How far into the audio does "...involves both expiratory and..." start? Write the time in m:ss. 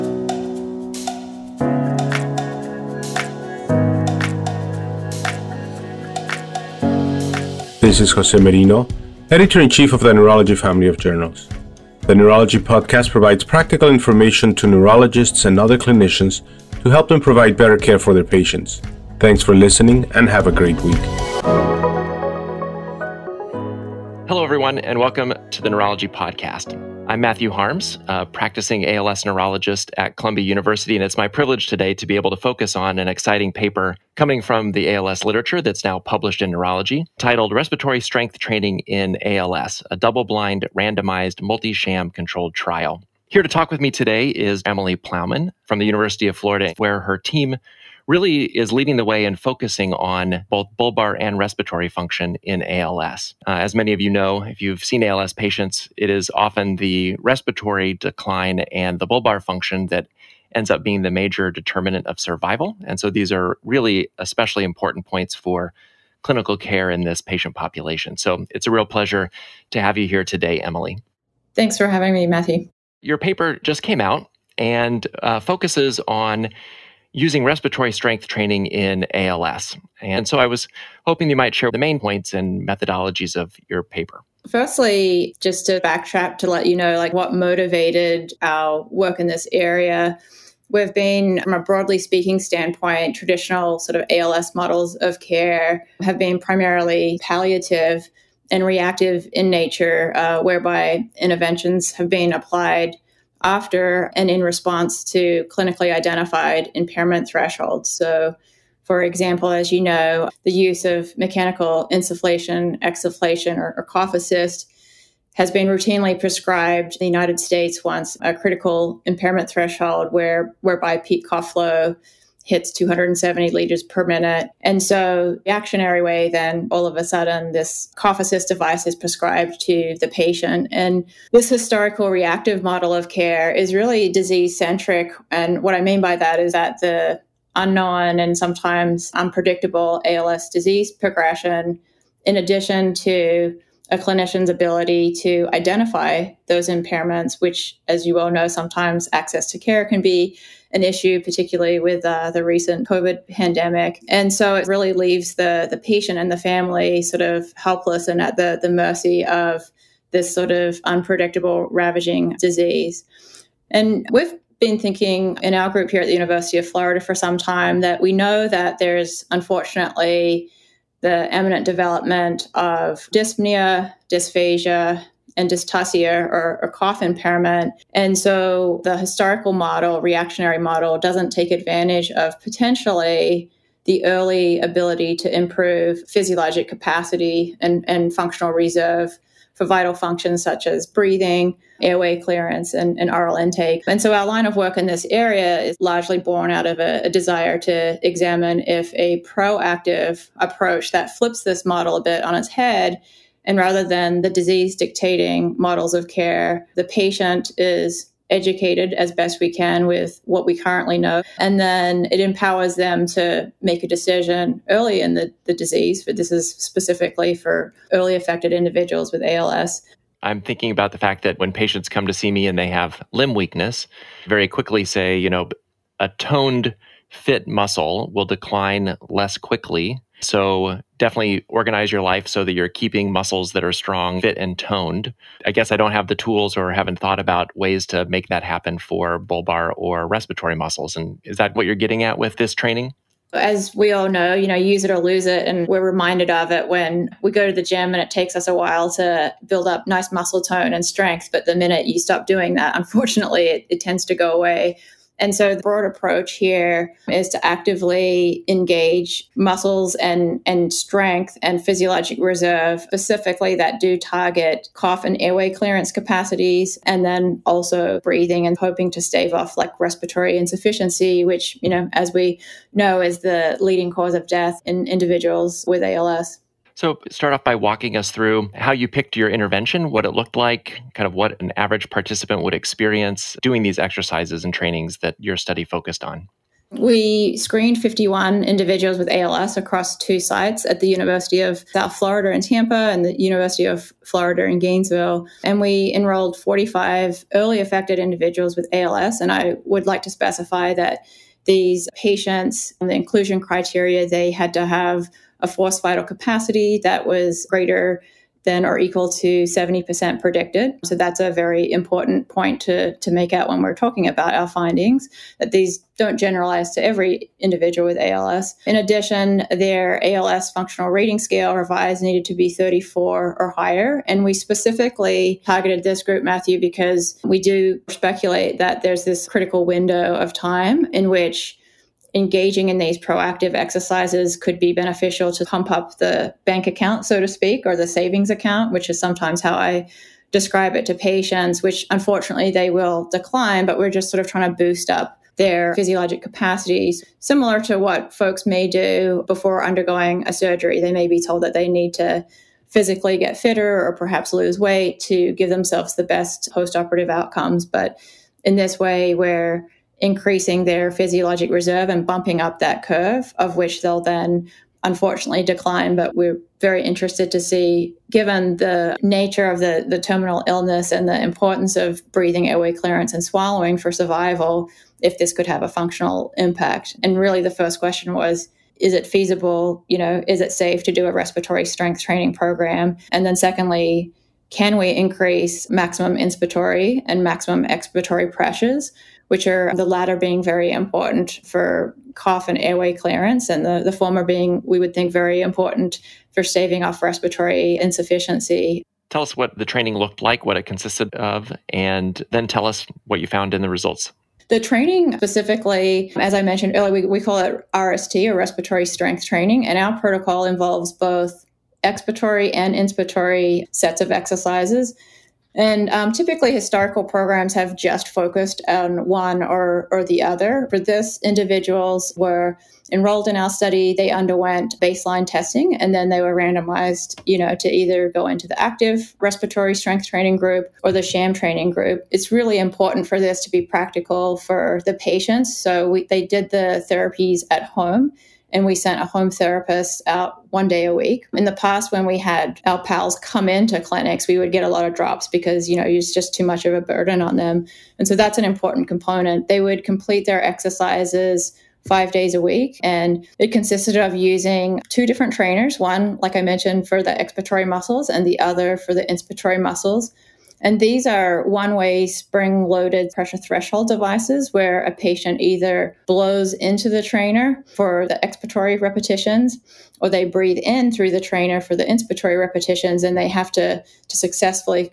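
6:50.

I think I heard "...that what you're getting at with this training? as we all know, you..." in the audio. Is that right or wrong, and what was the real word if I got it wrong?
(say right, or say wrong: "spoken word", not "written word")
right.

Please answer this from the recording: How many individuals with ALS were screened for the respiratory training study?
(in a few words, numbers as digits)
51.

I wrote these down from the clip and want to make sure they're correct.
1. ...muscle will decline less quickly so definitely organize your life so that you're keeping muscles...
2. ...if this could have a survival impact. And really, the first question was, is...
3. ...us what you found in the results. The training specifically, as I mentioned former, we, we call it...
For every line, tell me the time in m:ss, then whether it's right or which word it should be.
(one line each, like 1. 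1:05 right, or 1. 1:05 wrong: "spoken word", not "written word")
1. 3:47 right
2. 6:15 wrong: "functional", not "survival"
3. 6:42 wrong: "earlier", not "former".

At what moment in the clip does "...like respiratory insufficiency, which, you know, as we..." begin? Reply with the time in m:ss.
4:29.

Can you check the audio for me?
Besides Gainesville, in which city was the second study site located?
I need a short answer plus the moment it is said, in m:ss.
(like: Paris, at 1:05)
Tampa, at 4:52.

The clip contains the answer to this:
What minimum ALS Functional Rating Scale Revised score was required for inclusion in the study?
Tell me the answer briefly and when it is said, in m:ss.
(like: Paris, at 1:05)
34, at 5:22.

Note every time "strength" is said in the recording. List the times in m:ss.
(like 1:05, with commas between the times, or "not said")
0:37, 1:17, 4:10, 4:20, 6:21, 6:48, 7:09.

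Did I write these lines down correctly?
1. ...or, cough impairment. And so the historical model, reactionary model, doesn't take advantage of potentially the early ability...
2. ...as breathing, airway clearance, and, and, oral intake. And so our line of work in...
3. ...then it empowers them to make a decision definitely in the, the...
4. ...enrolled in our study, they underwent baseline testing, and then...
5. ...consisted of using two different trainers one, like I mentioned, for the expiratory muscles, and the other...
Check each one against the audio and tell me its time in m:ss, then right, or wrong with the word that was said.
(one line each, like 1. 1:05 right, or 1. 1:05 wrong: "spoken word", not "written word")
1. 2:56 right
2. 3:10 right
3. 3:31 wrong: "early", not "definitely"
4. 7:02 right
5. 7:33 right.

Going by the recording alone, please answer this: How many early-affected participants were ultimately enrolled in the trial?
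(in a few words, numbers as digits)
45.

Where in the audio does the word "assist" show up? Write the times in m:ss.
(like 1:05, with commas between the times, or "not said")
1:54, 2:08.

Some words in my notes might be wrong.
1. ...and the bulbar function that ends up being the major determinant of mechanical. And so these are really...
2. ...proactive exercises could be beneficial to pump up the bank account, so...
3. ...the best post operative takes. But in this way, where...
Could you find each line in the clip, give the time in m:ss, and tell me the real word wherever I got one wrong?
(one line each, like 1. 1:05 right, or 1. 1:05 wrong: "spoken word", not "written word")
1. 0:58 wrong: "survival", not "mechanical"
2. 5:32 right
3. 5:55 wrong: "outcomes", not "takes".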